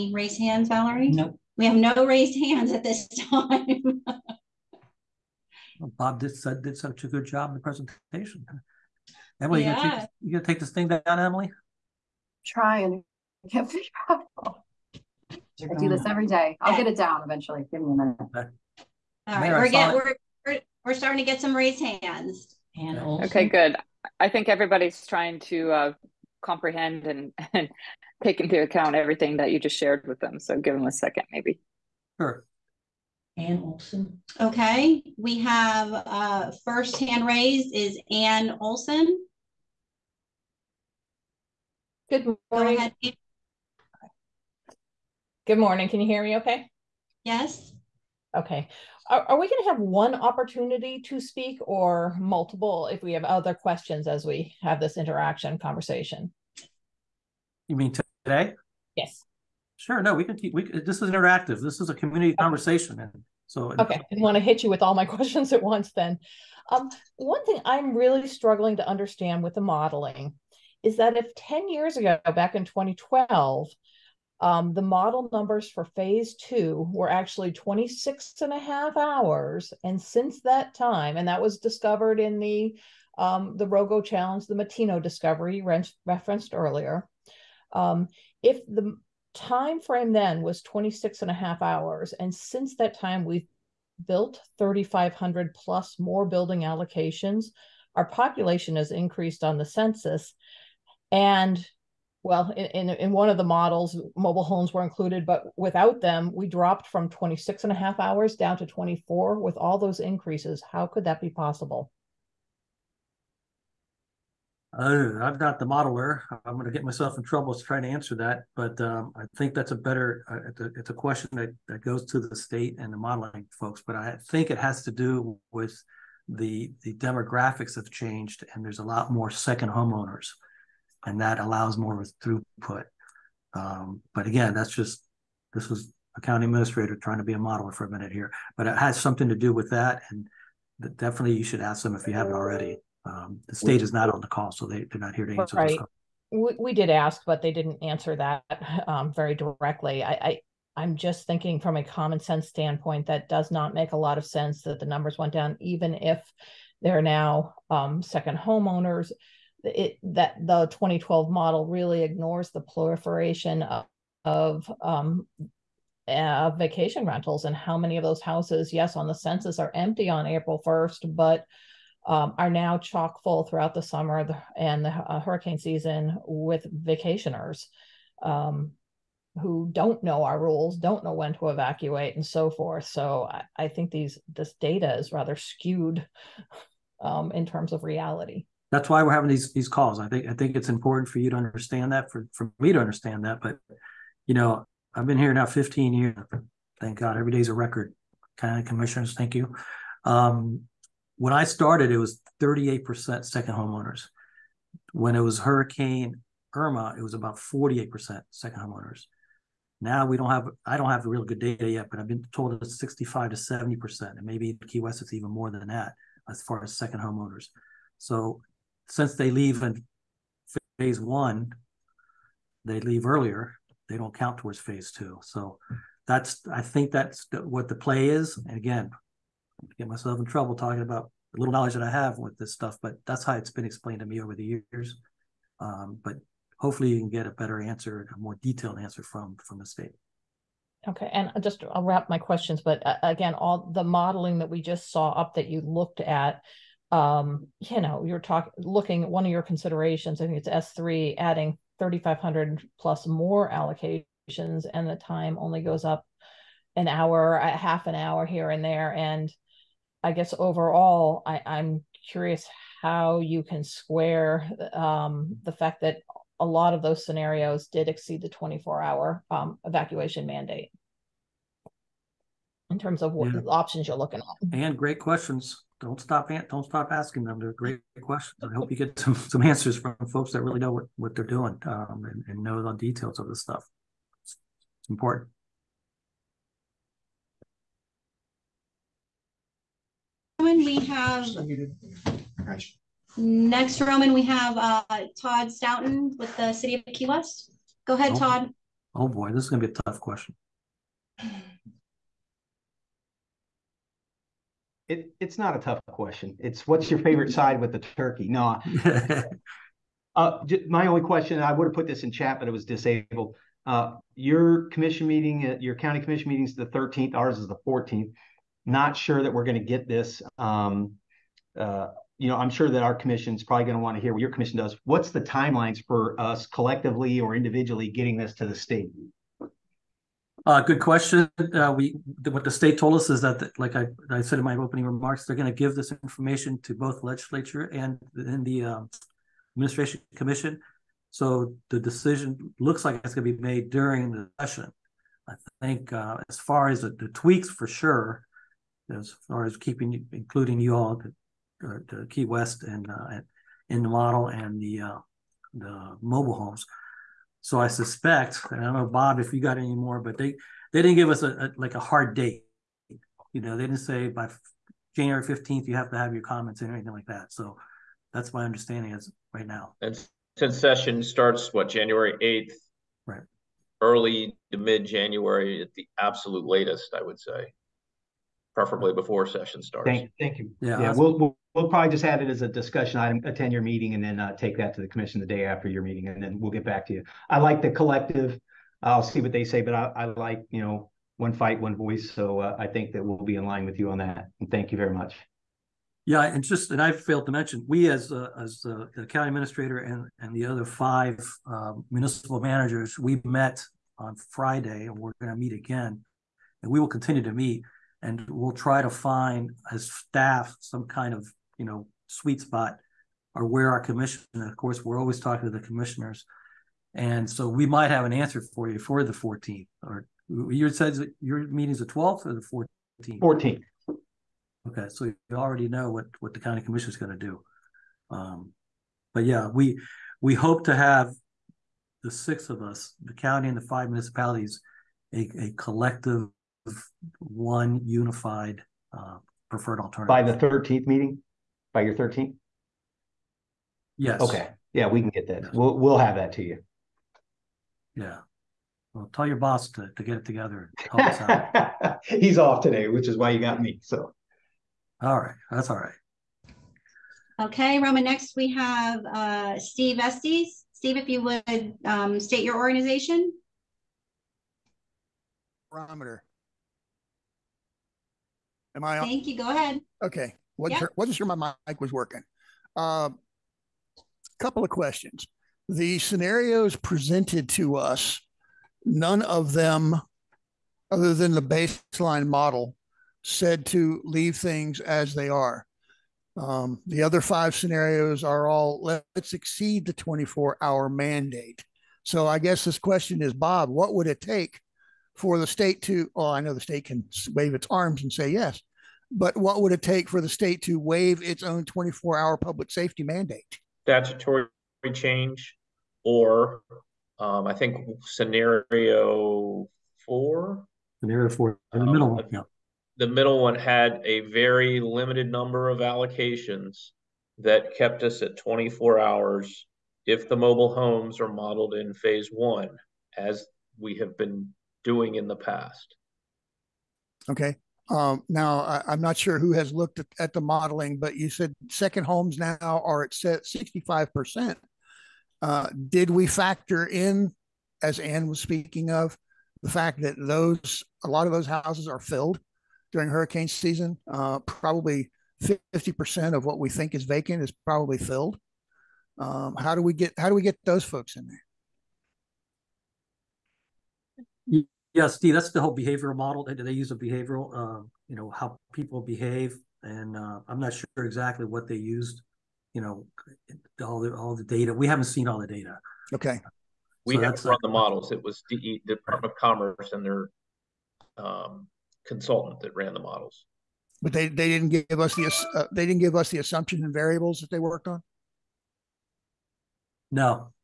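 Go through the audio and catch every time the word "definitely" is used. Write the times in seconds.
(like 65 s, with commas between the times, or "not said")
140 s.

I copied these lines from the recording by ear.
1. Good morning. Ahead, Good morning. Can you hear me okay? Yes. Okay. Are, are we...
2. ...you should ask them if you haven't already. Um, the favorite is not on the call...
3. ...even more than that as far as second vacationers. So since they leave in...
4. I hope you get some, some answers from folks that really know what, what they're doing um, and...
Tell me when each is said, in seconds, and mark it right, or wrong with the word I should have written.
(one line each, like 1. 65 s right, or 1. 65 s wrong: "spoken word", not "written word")
1. 42 s right
2. 141 s wrong: "state", not "favorite"
3. 215 s wrong: "homeowners", not "vacationers"
4. 278 s right.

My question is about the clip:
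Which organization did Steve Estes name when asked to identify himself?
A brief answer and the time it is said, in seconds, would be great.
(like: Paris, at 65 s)
Barometer, at 465 s.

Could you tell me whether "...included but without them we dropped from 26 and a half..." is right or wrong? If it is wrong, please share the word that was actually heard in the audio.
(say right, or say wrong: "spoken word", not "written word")
right.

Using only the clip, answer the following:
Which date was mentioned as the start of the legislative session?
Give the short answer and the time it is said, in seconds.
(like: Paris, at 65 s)
January 8, at 371 s.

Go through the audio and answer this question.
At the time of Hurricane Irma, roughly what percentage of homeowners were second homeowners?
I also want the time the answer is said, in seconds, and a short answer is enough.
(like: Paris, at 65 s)
48%, at 207 s.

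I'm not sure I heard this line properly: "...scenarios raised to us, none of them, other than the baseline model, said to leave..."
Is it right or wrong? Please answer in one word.
wrong.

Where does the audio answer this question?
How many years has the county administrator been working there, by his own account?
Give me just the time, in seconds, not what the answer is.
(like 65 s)
195 s.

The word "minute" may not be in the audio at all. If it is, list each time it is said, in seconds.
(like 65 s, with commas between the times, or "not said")
17 s, 137 s.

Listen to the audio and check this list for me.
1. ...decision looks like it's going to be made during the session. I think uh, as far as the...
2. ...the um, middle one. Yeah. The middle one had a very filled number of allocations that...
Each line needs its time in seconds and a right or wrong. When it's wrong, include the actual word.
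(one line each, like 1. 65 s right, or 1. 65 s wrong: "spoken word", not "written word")
1. 341 s right
2. 511 s wrong: "limited", not "filled".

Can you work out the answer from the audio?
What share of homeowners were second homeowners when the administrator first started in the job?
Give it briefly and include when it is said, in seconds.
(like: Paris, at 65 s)
38%, at 202 s.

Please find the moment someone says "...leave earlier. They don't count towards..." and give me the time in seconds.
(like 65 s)
222 s.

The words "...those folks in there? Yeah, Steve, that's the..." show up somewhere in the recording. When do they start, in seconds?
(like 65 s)
550 s.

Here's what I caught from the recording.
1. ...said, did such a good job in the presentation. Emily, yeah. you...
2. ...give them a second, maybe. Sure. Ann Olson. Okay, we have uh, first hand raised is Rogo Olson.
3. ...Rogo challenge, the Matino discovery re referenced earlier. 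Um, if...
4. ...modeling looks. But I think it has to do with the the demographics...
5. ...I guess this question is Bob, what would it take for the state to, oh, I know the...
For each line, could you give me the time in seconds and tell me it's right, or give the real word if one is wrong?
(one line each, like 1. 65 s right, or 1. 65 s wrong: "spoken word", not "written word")
1. 6 s right
2. 30 s wrong: "Ann", not "Rogo"
3. 83 s right
4. 122 s wrong: "folks", not "looks"
5. 492 s right.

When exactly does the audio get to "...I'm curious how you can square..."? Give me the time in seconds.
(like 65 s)
261 s.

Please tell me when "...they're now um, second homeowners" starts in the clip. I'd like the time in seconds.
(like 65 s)
156 s.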